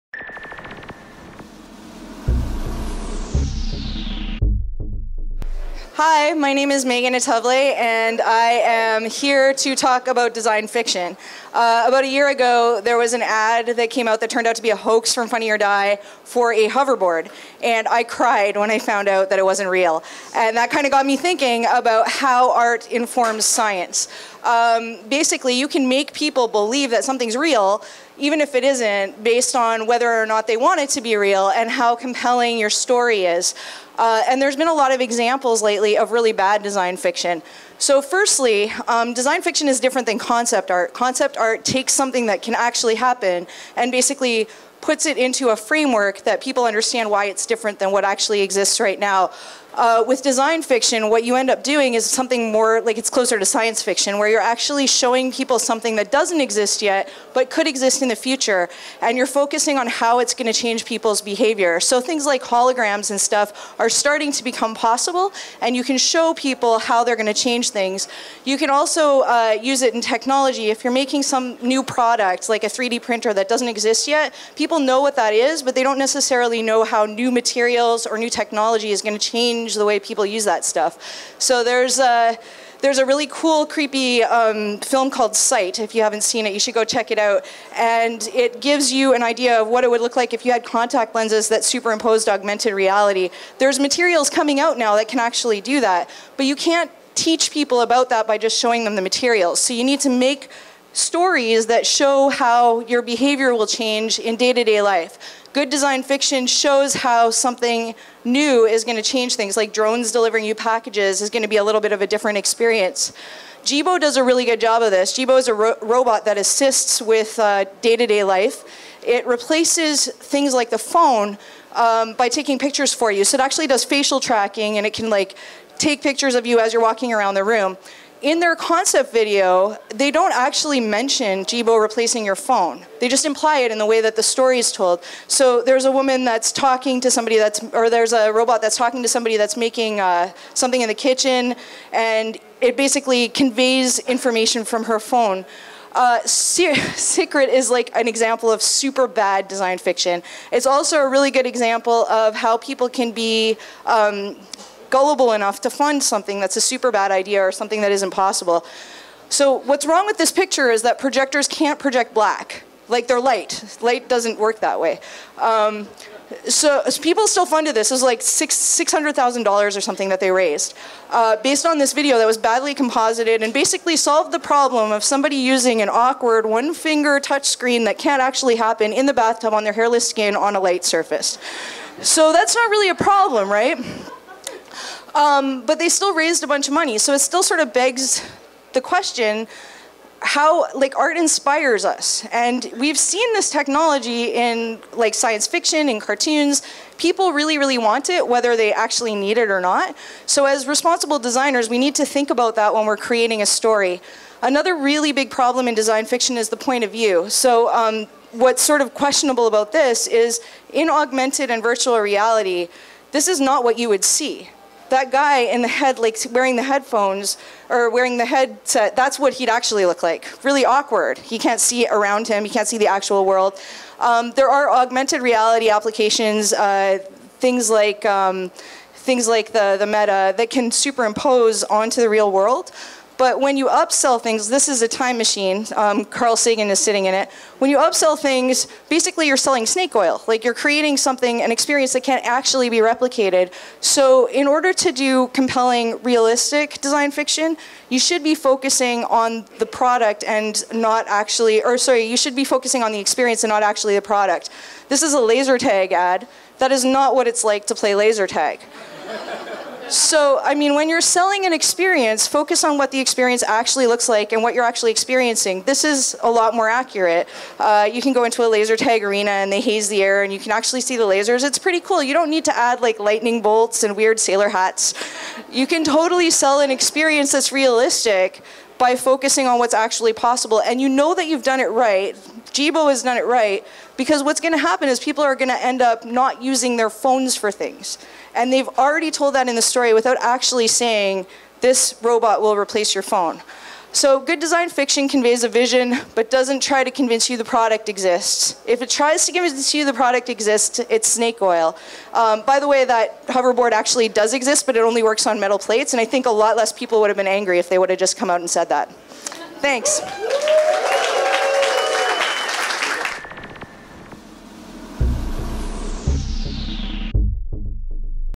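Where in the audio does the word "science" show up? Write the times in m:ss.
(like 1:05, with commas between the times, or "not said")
0:23, 0:53, 3:15.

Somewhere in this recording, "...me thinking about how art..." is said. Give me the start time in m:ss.
0:21.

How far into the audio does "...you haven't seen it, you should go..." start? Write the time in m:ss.
1:25.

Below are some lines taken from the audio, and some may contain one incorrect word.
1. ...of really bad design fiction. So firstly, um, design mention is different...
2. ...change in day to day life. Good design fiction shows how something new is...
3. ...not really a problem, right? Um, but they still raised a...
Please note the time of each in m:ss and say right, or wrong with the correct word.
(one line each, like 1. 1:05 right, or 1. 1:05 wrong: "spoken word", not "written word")
1. 0:35 wrong: "fiction", not "mention"
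2. 1:43 right
3. 3:02 right.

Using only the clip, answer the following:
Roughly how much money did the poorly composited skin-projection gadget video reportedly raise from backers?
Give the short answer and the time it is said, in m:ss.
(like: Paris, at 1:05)
$600,000, at 2:48.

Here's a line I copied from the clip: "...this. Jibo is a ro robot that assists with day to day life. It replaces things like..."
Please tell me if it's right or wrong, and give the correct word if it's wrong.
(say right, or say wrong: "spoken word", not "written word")
right.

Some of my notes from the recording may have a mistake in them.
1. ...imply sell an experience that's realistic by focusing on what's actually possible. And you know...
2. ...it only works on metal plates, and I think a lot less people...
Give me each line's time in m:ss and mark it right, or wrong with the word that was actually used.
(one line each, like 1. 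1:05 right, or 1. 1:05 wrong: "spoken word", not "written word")
1. 4:35 wrong: "totally", not "imply"
2. 5:04 right.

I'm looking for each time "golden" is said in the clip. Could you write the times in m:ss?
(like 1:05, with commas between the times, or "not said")
not said.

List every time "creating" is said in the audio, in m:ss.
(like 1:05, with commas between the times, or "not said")
3:22, 4:00.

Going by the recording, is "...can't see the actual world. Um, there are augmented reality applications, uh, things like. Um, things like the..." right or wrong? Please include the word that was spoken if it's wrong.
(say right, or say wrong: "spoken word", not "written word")
right.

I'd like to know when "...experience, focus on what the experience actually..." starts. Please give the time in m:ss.
4:21.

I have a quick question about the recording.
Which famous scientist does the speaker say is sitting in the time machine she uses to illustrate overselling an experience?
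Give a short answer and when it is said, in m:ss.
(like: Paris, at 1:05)
Carl Sagan, at 3:56.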